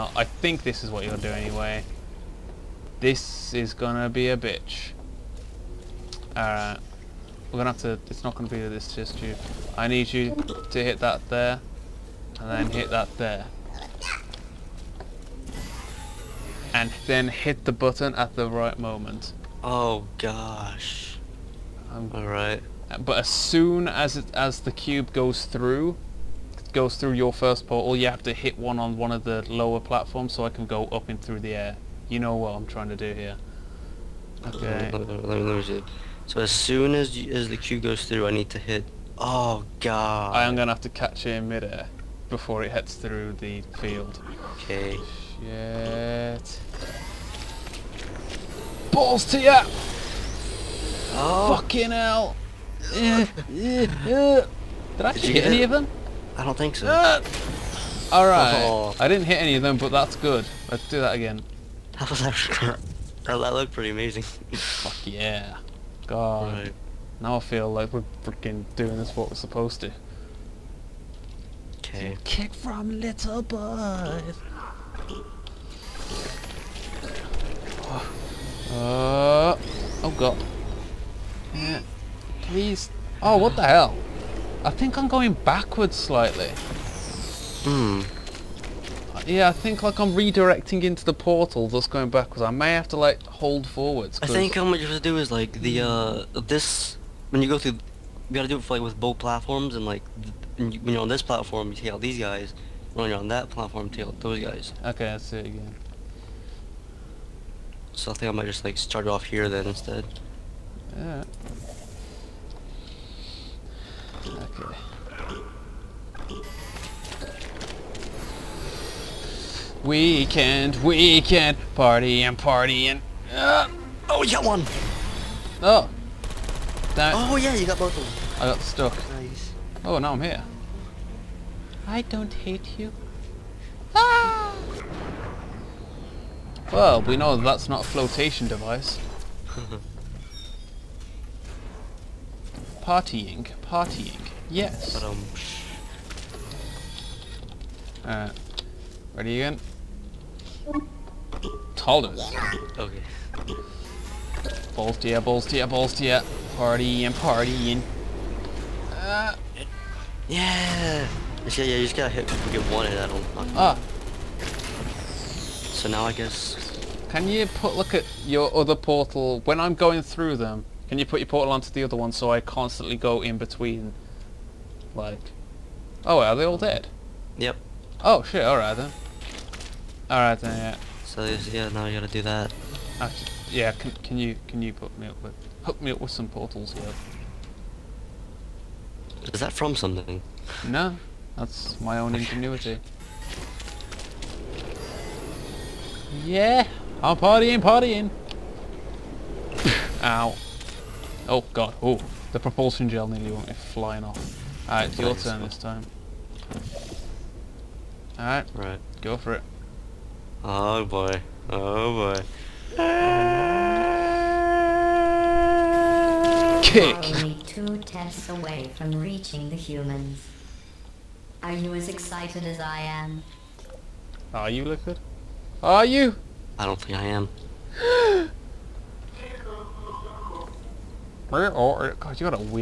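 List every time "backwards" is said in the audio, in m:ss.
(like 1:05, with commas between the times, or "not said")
1:25, 1:32.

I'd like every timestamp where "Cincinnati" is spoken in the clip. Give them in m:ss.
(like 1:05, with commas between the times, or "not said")
not said.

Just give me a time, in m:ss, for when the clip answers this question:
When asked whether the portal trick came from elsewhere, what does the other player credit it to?
3:11.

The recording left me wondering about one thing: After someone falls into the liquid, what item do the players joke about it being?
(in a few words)
flotation device.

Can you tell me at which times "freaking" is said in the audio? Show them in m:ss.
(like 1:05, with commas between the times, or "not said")
1:08.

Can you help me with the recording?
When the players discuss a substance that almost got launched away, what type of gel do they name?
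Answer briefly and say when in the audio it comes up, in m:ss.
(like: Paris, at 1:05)
propulsion gel, at 3:22.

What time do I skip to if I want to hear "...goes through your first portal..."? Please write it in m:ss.
0:26.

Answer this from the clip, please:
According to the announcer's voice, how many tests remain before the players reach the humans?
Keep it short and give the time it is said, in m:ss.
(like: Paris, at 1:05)
2, at 3:37.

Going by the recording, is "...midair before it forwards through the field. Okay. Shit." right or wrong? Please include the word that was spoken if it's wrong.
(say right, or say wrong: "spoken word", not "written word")
wrong: "heads", not "forwards".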